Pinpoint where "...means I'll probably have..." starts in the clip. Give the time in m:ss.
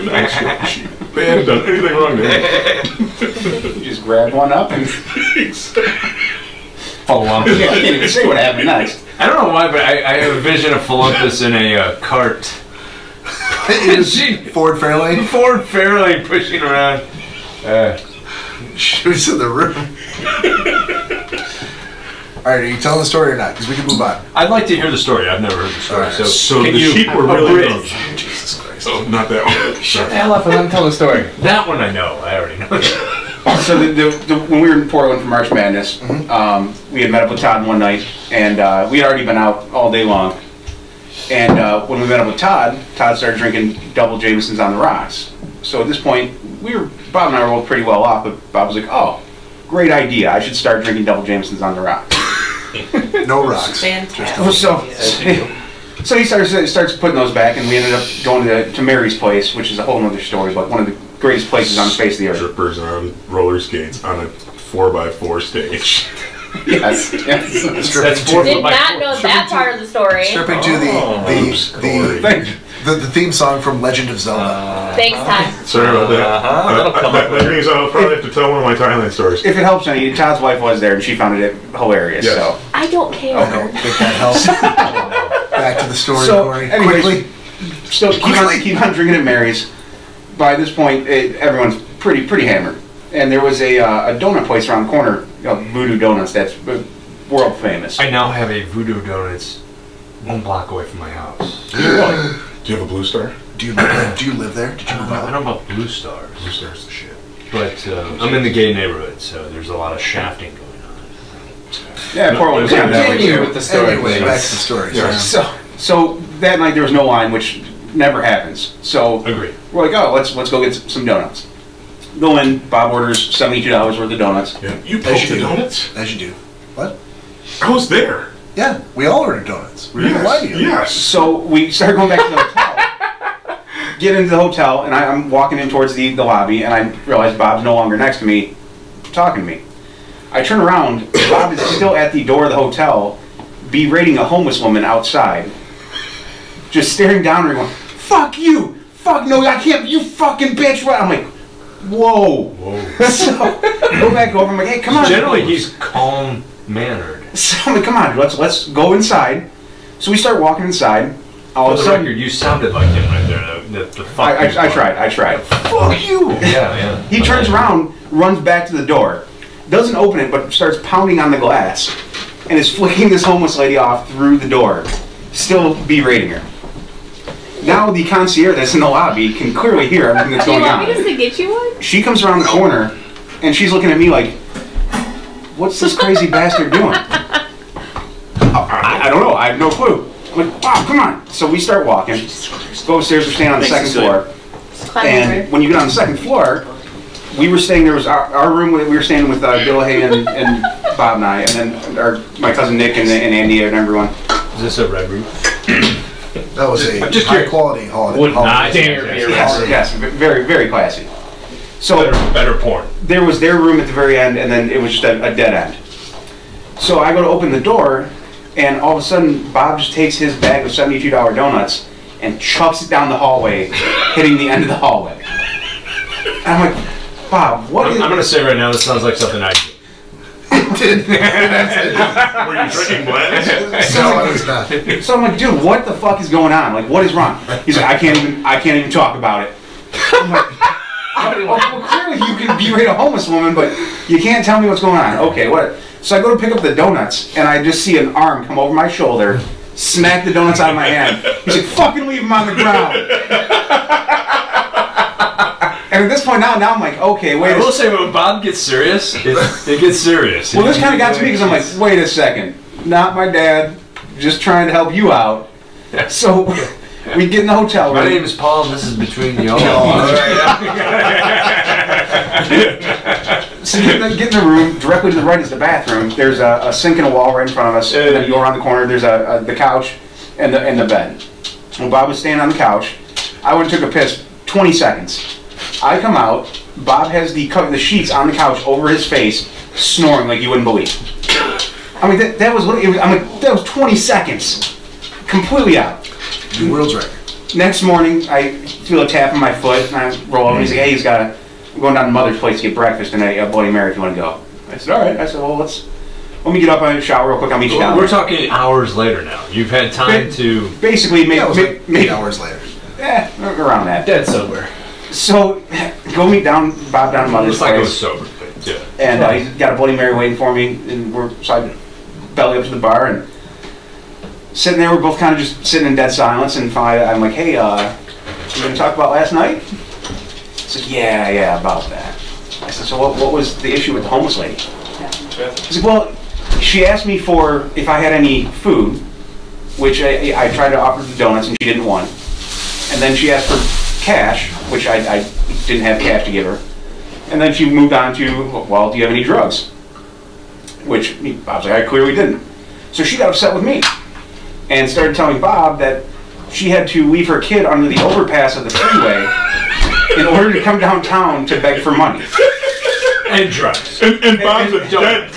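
1:17.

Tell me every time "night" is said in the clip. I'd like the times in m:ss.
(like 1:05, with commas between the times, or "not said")
0:37, 1:56, 5:29.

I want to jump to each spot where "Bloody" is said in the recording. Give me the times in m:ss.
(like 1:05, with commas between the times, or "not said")
5:03, 5:19.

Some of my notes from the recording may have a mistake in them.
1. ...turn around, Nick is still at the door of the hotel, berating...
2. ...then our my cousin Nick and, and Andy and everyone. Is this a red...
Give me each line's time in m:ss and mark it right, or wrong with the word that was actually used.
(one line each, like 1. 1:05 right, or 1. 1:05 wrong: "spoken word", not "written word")
1. 2:20 wrong: "Bob", not "Nick"
2. 3:21 right.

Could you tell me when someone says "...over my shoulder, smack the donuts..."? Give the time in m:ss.
4:08.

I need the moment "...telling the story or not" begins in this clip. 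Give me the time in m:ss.
0:22.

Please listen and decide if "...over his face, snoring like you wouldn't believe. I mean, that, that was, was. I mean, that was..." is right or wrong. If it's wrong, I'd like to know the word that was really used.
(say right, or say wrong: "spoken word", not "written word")
right.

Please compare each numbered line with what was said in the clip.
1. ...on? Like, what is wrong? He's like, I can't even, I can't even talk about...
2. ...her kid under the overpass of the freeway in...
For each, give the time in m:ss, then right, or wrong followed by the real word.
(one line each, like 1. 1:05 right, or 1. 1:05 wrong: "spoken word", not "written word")
1. 3:56 right
2. 5:57 right.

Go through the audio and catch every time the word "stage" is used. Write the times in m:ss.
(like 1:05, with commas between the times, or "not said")
1:05.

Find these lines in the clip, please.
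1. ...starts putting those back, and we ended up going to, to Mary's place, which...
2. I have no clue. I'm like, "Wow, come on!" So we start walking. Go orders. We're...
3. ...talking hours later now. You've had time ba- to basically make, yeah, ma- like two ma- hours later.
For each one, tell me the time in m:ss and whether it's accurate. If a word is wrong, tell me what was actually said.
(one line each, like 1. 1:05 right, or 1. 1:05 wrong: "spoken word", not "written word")
1. 0:56 right
2. 3:09 wrong: "upstairs", not "orders"
3. 5:08 wrong: "eight", not "two".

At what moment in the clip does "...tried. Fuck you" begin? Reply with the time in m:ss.
2:45.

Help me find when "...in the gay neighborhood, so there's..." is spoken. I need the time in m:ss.
1:48.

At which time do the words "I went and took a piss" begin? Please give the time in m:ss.
4:43.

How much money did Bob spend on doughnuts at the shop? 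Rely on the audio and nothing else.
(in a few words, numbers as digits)
$72.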